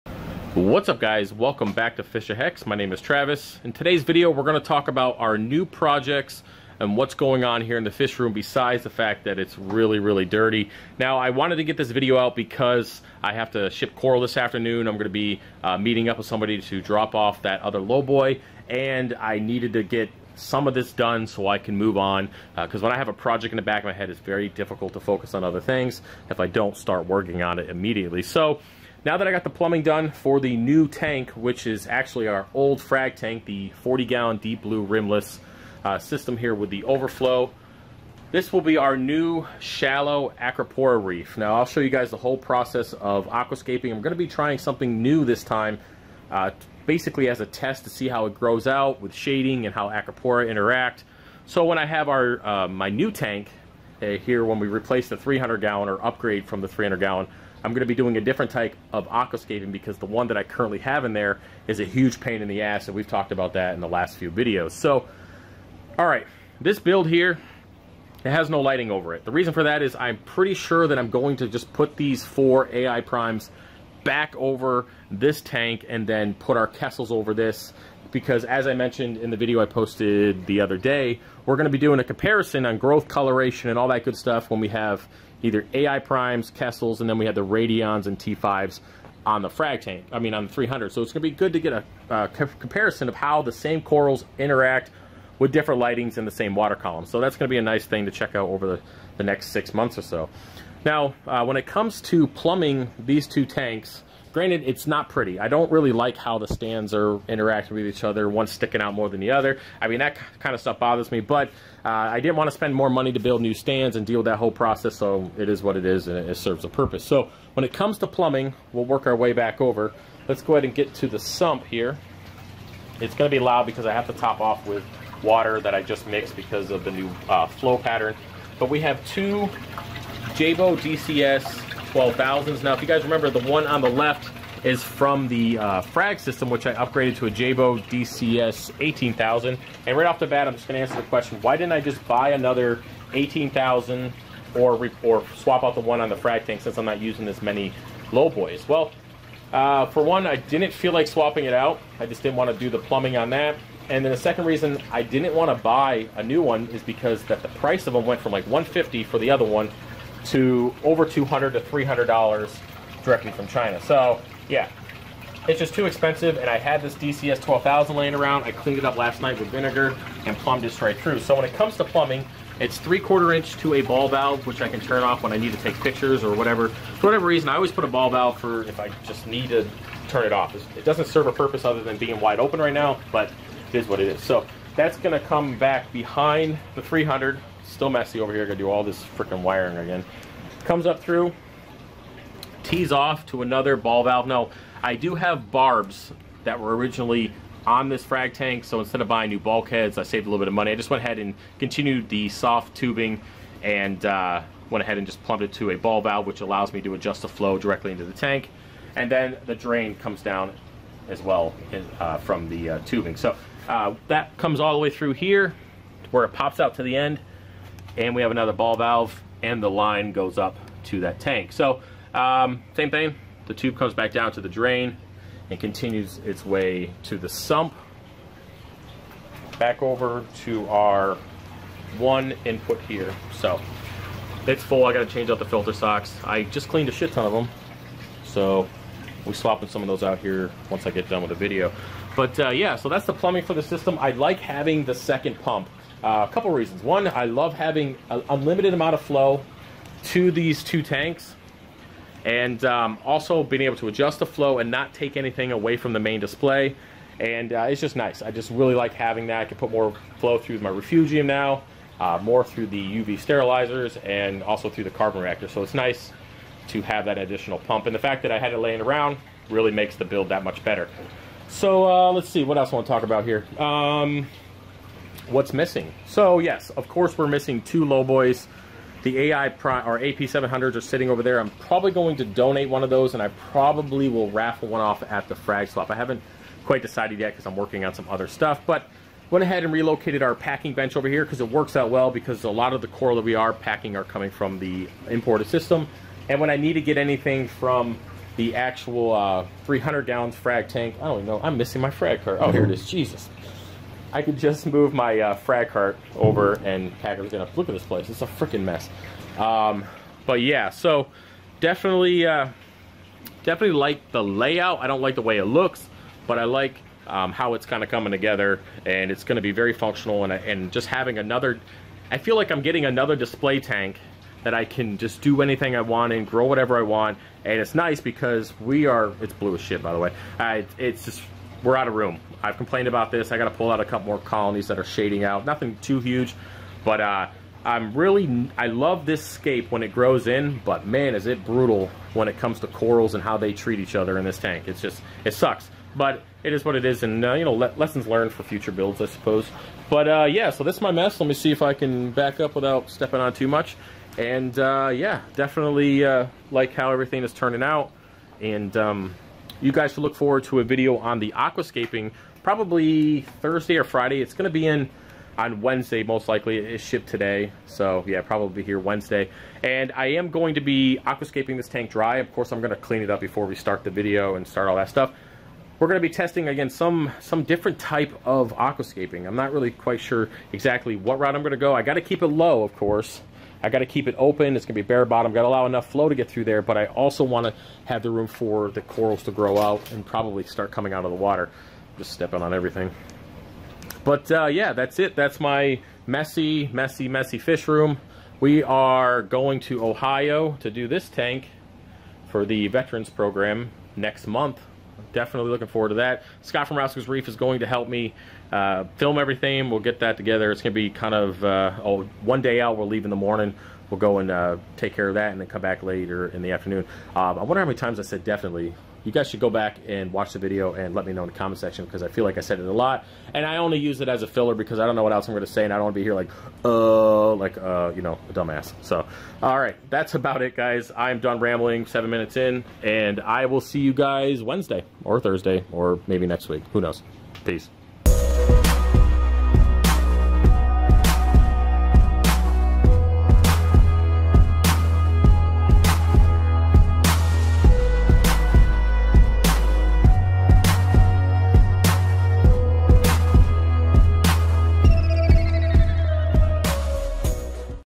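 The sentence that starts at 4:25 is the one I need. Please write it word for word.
So it's nice to have that additional pump.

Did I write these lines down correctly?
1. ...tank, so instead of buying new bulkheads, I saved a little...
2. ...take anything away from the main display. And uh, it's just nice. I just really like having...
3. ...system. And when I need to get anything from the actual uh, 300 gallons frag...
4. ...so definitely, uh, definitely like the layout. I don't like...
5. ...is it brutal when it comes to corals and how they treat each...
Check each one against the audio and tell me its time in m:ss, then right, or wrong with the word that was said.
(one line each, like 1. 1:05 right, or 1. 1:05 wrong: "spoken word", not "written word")
1. 3:18 right
2. 4:14 right
3. 4:55 right
4. 5:10 right
5. 5:41 right.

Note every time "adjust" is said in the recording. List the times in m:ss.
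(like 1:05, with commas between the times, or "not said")
3:26, 4:13.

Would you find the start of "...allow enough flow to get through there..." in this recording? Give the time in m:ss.
6:25.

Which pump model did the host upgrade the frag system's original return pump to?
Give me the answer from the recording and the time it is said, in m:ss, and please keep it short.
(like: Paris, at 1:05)
Jebao DCS 18,000, at 2:17.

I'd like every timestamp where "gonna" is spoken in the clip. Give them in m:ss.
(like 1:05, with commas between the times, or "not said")
0:04, 0:14, 3:04, 5:07, 5:19.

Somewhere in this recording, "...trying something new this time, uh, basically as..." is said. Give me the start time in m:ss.
0:44.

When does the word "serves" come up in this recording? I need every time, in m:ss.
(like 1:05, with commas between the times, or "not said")
1:56, 3:01.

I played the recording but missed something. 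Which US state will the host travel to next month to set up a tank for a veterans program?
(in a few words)
Ohio.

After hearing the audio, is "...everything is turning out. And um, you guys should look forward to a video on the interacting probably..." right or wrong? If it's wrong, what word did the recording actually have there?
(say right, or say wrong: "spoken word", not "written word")
wrong: "aquascaping", not "interacting".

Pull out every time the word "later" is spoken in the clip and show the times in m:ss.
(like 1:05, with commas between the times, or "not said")
6:55.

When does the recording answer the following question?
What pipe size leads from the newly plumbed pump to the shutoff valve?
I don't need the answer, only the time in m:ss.
2:52.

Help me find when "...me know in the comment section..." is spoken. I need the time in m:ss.
7:01.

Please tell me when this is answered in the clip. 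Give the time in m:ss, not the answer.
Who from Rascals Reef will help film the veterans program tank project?
6:46.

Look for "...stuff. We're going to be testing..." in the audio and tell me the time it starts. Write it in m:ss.
6:14.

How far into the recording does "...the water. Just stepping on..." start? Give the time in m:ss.
6:31.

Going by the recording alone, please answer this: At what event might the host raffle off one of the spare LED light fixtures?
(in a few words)
the frag swap.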